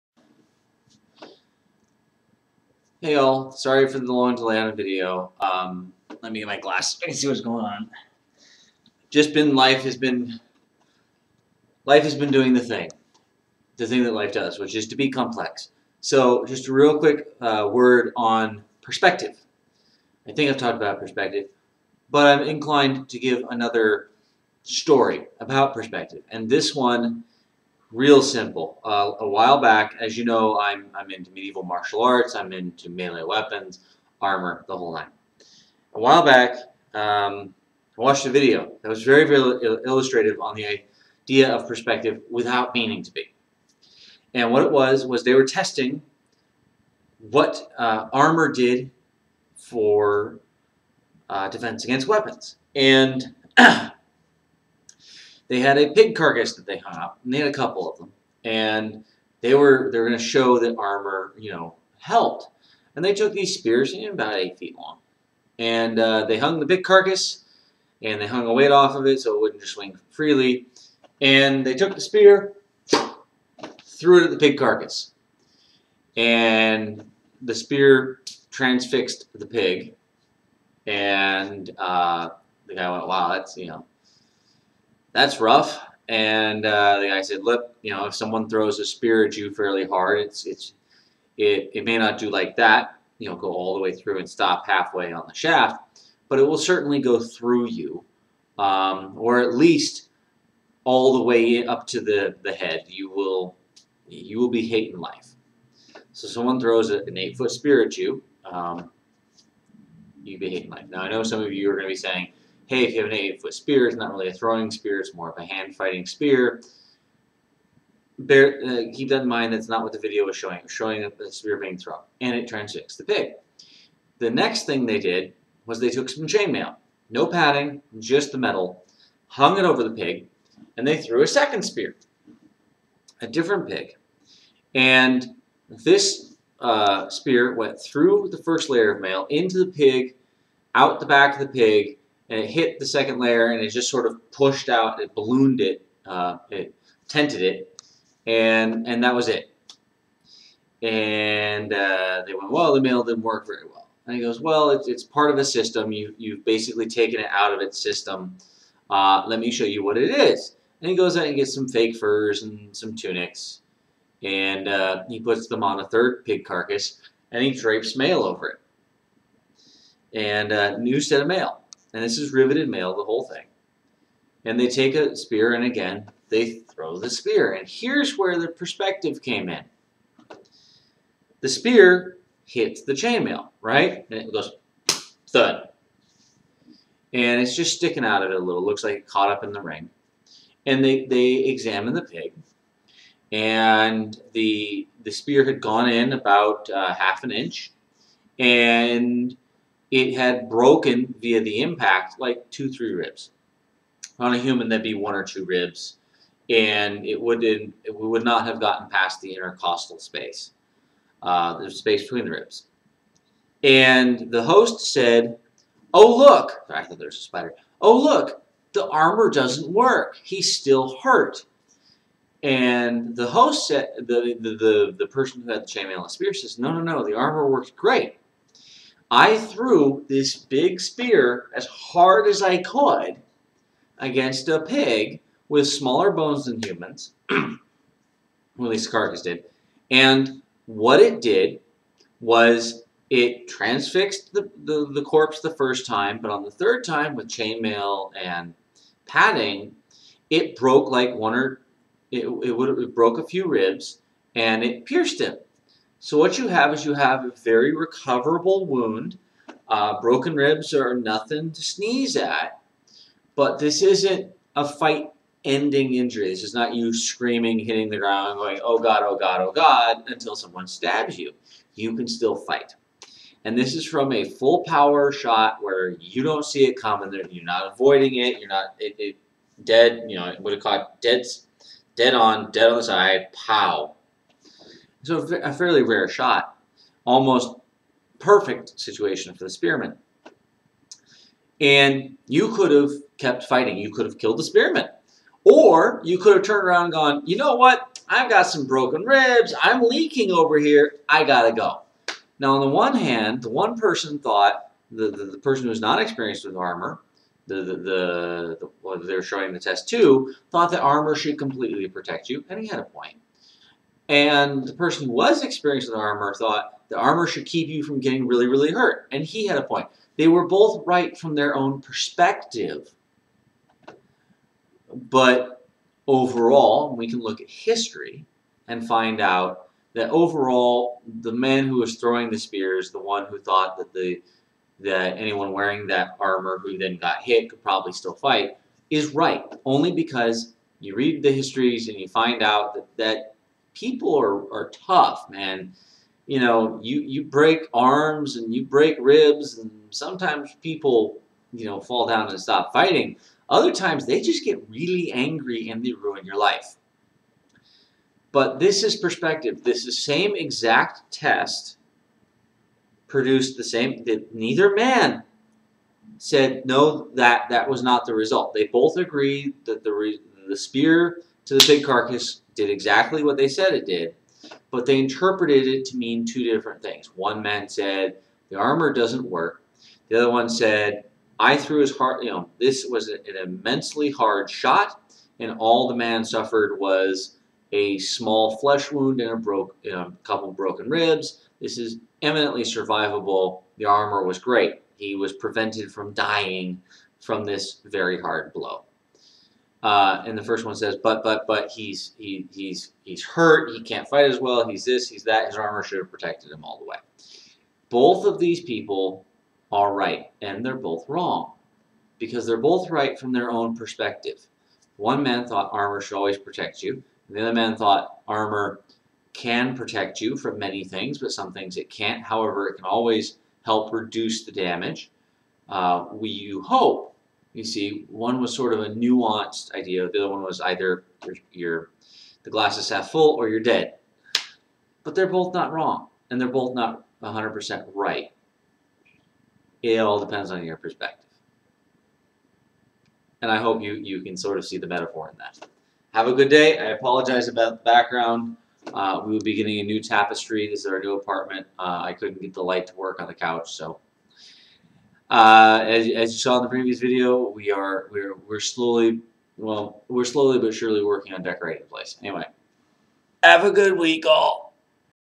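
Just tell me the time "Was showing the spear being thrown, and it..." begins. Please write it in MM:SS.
02:00.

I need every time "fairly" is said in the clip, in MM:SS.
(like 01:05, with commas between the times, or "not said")
01:29, 04:45.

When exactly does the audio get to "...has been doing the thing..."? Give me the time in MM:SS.
00:12.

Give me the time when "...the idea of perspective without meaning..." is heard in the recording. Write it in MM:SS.
00:40.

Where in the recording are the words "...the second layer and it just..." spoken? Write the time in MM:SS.
02:22.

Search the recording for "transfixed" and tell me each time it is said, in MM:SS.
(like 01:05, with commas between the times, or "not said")
01:18, 02:02, 04:03.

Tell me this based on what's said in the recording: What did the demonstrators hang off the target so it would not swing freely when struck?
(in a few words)
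A weight.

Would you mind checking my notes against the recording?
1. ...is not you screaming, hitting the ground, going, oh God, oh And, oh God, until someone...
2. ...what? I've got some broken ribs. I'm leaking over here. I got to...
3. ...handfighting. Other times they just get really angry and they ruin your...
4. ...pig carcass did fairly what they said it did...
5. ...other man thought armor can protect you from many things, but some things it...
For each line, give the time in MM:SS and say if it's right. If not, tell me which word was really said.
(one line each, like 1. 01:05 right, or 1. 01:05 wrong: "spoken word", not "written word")
1. 04:26 wrong: "God", not "And"
2. 04:57 right
3. 05:52 wrong: "fighting", not "handfighting"
4. 06:11 wrong: "exactly", not "fairly"
5. 06:57 right.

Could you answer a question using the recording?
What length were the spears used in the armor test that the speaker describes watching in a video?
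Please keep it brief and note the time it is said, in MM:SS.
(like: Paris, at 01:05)
8 feet, at 01:03.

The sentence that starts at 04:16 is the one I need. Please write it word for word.
So what you have is you have a very recoverable wound.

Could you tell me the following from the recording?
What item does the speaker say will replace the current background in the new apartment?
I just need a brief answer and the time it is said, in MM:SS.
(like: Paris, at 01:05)
A new tapestry, at 07:29.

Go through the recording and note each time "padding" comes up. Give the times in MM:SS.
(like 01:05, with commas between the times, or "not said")
02:07, 04:09.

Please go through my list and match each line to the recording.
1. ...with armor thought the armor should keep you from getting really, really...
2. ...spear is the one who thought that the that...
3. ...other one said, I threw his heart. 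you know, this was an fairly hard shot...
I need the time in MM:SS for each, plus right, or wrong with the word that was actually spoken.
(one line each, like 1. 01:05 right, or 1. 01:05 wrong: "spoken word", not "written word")
1. 05:15 right
2. 05:32 right
3. 06:20 wrong: "immensely", not "fairly".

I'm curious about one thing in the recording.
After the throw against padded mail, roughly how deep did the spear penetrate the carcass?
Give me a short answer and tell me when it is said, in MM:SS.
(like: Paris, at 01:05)
Half an inch, at 03:16.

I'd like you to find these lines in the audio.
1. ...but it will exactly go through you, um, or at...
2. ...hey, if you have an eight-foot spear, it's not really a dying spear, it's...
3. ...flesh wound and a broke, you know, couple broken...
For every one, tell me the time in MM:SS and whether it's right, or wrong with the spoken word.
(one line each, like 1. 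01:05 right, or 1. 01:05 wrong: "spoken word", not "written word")
1. 01:36 wrong: "certainly", not "exactly"
2. 01:52 wrong: "throwing", not "dying"
3. 06:28 right.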